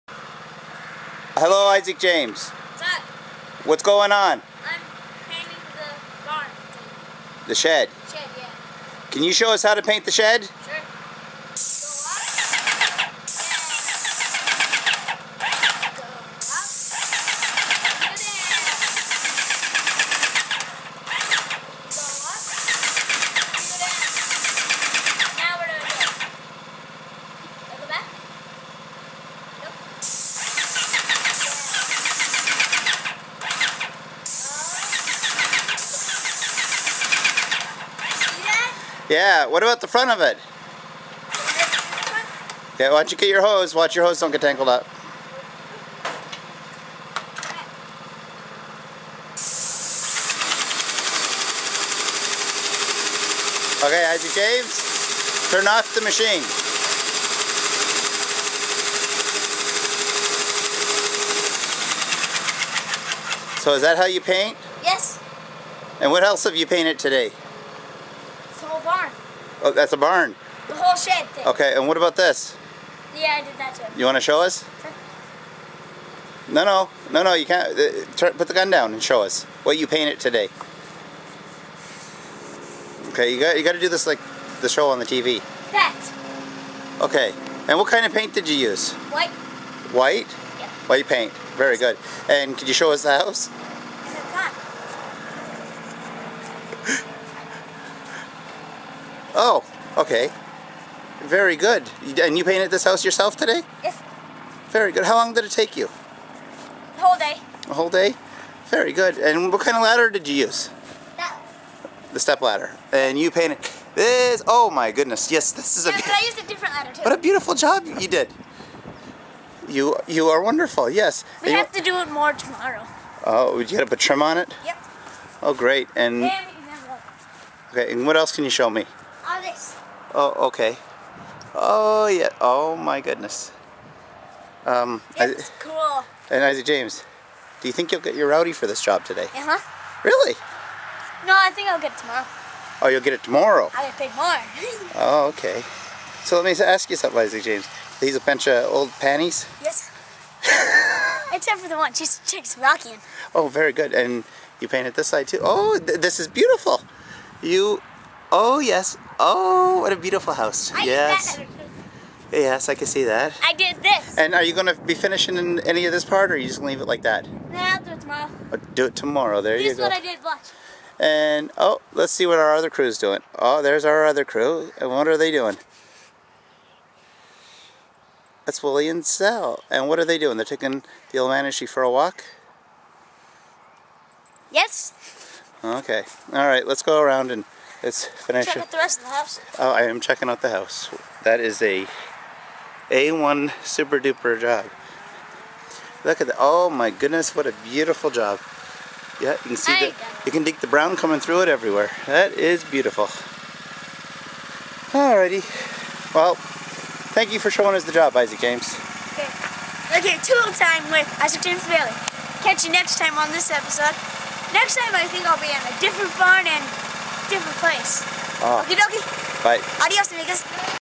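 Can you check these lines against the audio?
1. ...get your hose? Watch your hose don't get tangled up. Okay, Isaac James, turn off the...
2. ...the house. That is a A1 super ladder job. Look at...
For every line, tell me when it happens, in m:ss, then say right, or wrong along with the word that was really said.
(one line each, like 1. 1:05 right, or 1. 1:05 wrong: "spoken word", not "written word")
1. 0:43 right
2. 3:10 wrong: "duper", not "ladder".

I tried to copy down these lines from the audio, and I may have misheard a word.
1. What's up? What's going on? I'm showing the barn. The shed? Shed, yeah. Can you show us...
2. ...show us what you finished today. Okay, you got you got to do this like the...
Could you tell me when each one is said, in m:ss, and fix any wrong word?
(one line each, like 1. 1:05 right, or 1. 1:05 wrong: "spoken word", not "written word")
1. 0:02 wrong: "painting", not "showing"
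2. 1:19 wrong: "painted", not "finished".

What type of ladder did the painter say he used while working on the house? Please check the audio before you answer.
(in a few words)
Step ladder.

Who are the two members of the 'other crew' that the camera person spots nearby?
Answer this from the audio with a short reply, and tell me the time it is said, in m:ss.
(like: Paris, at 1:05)
Willie and Sal, at 2:58.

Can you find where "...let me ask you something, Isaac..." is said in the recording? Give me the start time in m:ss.
2:26.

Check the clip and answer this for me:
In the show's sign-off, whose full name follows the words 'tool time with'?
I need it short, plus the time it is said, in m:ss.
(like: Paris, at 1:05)
Isaac James Baillie, at 3:31.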